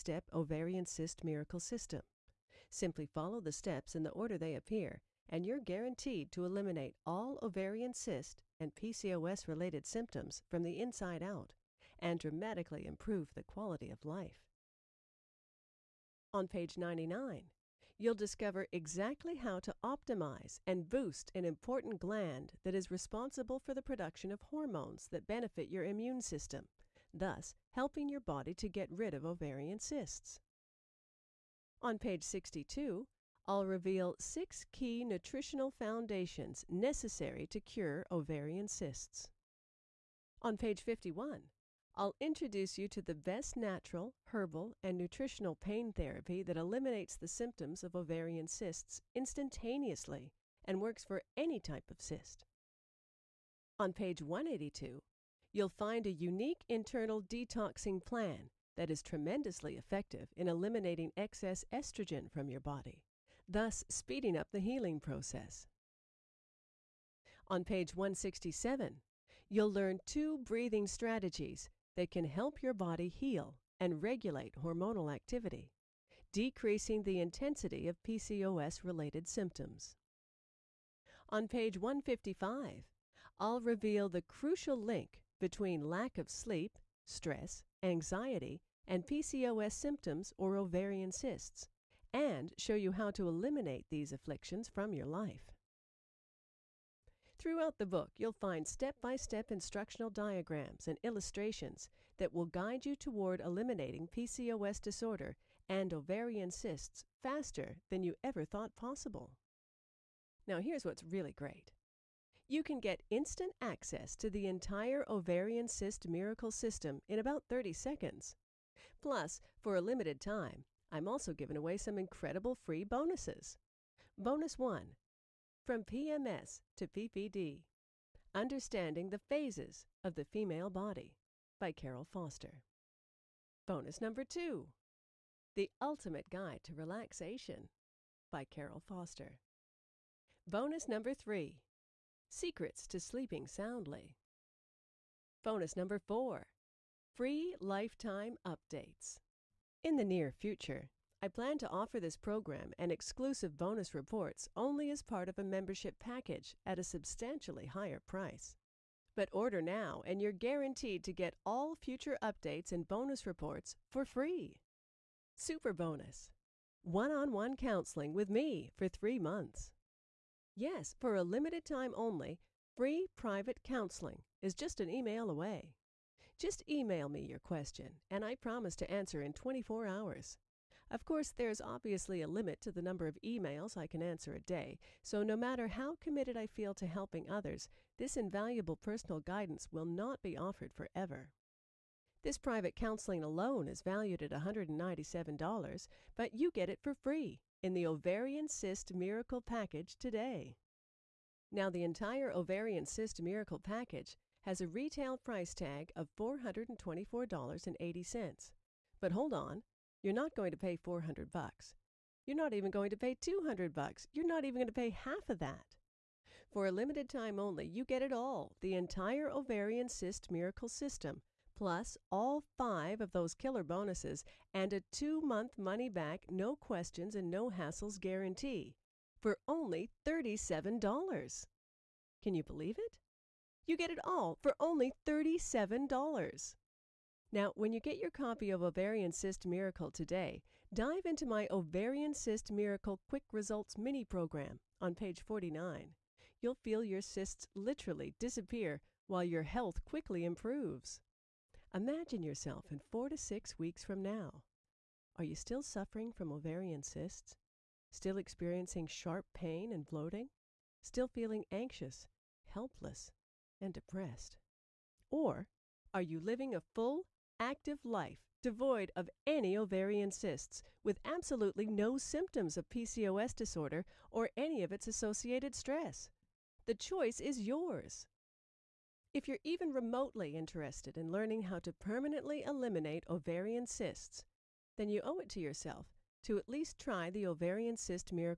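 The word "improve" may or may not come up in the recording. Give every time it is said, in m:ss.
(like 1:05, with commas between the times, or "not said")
0:12, 4:10.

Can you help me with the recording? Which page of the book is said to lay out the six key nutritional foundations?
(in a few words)
Page 62.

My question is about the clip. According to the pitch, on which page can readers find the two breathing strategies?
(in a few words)
Page 167.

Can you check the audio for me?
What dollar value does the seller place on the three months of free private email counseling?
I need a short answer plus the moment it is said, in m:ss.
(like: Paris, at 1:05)
$197, at 3:14.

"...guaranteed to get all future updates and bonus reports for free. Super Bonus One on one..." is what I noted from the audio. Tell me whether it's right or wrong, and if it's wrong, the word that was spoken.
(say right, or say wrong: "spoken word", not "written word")
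right.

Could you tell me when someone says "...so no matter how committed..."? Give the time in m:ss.
3:05.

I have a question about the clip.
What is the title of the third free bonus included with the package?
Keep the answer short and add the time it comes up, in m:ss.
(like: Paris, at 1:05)
Secrets to Sleeping Soundly, at 2:22.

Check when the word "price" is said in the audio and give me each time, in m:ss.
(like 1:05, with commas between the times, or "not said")
2:37, 3:25.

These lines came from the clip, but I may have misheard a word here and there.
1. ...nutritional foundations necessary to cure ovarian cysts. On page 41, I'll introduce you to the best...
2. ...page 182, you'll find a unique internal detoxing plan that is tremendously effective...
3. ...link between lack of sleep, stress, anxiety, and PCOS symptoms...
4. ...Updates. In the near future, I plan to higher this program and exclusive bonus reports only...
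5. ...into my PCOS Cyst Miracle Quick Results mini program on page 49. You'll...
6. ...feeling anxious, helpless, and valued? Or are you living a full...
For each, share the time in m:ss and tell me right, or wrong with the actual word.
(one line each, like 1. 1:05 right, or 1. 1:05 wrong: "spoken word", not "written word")
1. 0:35 wrong: "51", not "41"
2. 0:53 right
3. 1:24 right
4. 2:28 wrong: "offer", not "higher"
5. 4:01 wrong: "Ovarian", not "PCOS"
6. 4:21 wrong: "depressed", not "valued".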